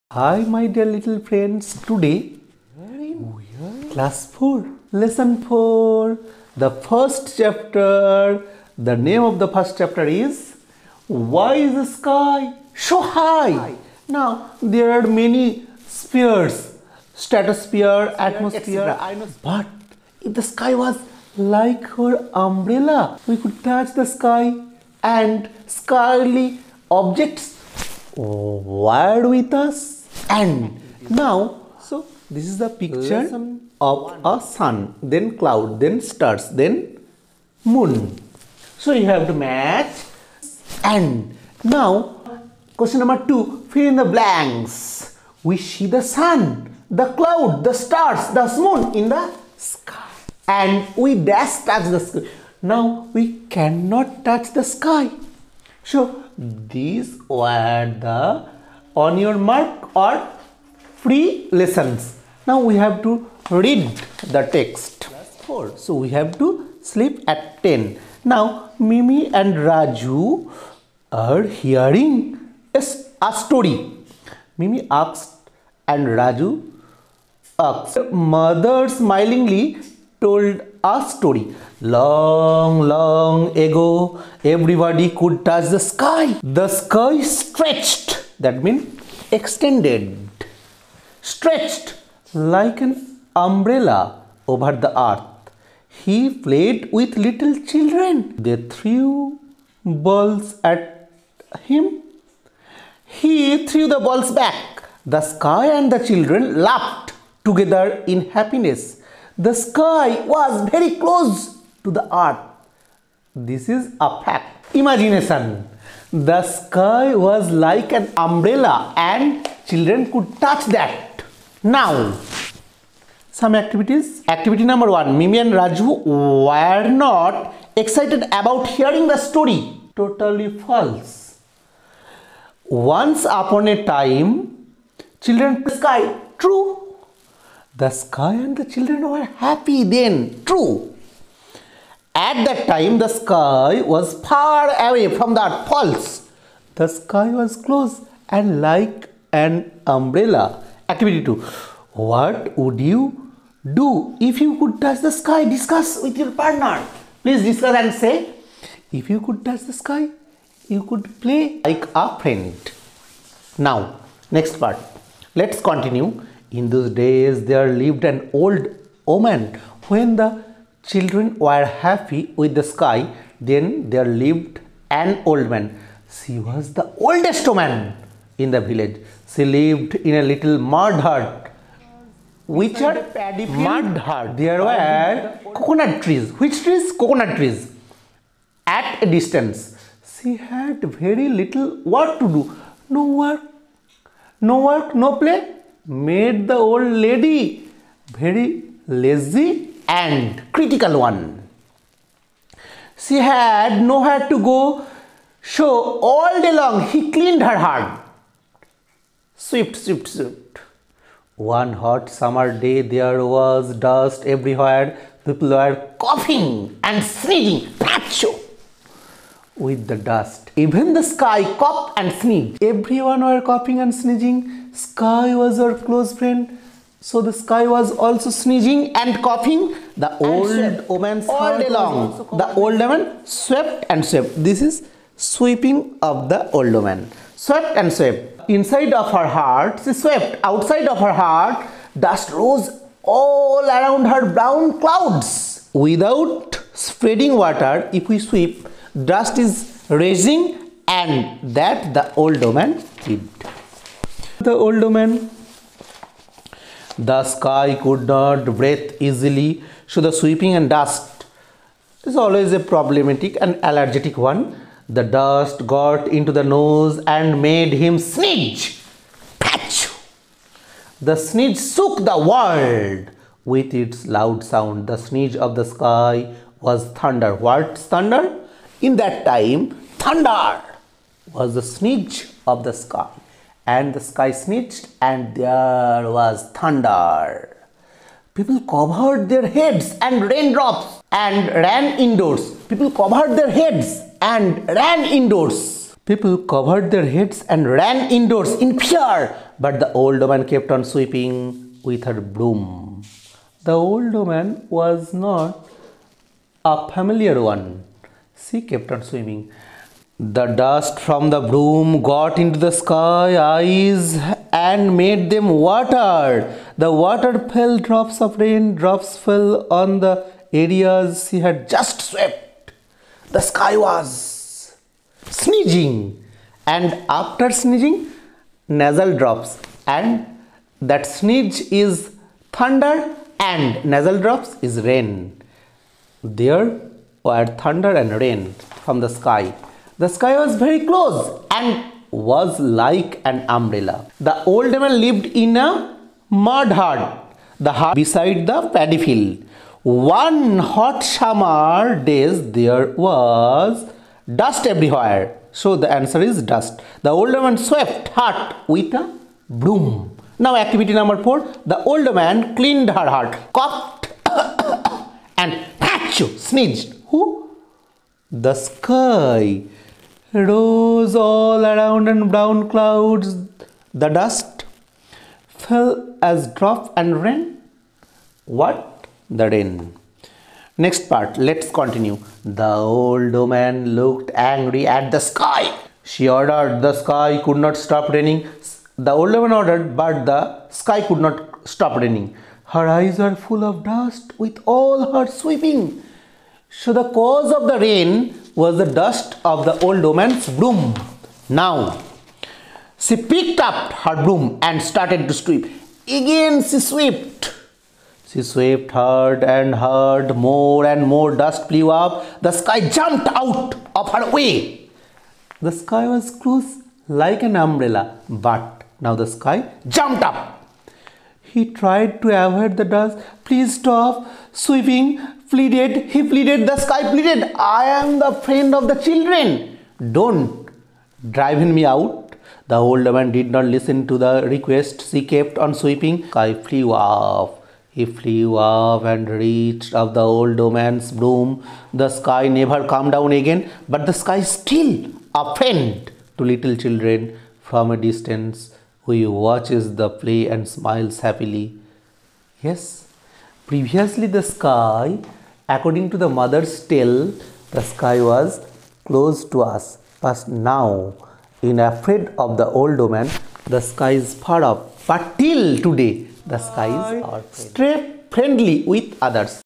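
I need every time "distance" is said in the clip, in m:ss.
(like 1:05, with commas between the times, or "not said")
3:09, 7:27.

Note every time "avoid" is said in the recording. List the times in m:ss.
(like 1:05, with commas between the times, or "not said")
7:02.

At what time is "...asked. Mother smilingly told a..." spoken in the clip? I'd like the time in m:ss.
1:17.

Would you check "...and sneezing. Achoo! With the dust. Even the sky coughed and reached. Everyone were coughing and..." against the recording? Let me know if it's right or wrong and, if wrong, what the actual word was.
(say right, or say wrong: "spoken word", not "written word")
wrong: "sneezed", not "reached".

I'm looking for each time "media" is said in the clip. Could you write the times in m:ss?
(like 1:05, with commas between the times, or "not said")
not said.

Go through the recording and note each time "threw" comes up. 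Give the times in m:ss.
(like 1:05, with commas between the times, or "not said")
1:38, 1:43.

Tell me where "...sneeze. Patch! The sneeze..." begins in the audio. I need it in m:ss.
4:27.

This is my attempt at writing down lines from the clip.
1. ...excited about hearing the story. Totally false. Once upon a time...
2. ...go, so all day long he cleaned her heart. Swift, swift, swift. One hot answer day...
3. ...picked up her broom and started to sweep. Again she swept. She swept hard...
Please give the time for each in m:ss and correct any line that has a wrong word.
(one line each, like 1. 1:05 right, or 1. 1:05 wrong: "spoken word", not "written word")
1. 2:07 right
2. 3:24 wrong: "summer", not "answer"
3. 6:43 right.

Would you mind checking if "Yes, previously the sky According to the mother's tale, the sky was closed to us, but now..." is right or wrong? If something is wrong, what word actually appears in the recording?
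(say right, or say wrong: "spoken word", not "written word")
right.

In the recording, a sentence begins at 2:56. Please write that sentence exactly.
She was the oldest woman in the village.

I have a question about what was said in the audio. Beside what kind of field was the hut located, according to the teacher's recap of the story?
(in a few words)
Paddy field.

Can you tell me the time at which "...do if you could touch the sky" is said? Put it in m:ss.
2:33.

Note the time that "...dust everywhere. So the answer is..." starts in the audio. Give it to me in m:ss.
5:54.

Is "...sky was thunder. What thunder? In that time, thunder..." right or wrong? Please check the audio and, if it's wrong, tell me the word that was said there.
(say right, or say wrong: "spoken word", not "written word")
right.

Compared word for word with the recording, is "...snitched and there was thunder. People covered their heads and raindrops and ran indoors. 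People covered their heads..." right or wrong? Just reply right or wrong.
right.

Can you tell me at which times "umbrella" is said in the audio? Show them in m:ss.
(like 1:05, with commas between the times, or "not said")
0:22, 1:33, 1:58, 2:29, 5:43, 6:57.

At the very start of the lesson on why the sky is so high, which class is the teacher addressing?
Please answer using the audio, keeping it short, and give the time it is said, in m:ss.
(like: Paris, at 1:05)
Class 4, at 0:03.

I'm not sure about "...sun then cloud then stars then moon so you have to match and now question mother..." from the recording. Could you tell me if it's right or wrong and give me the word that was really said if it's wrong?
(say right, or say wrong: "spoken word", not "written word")
wrong: "number", not "mother".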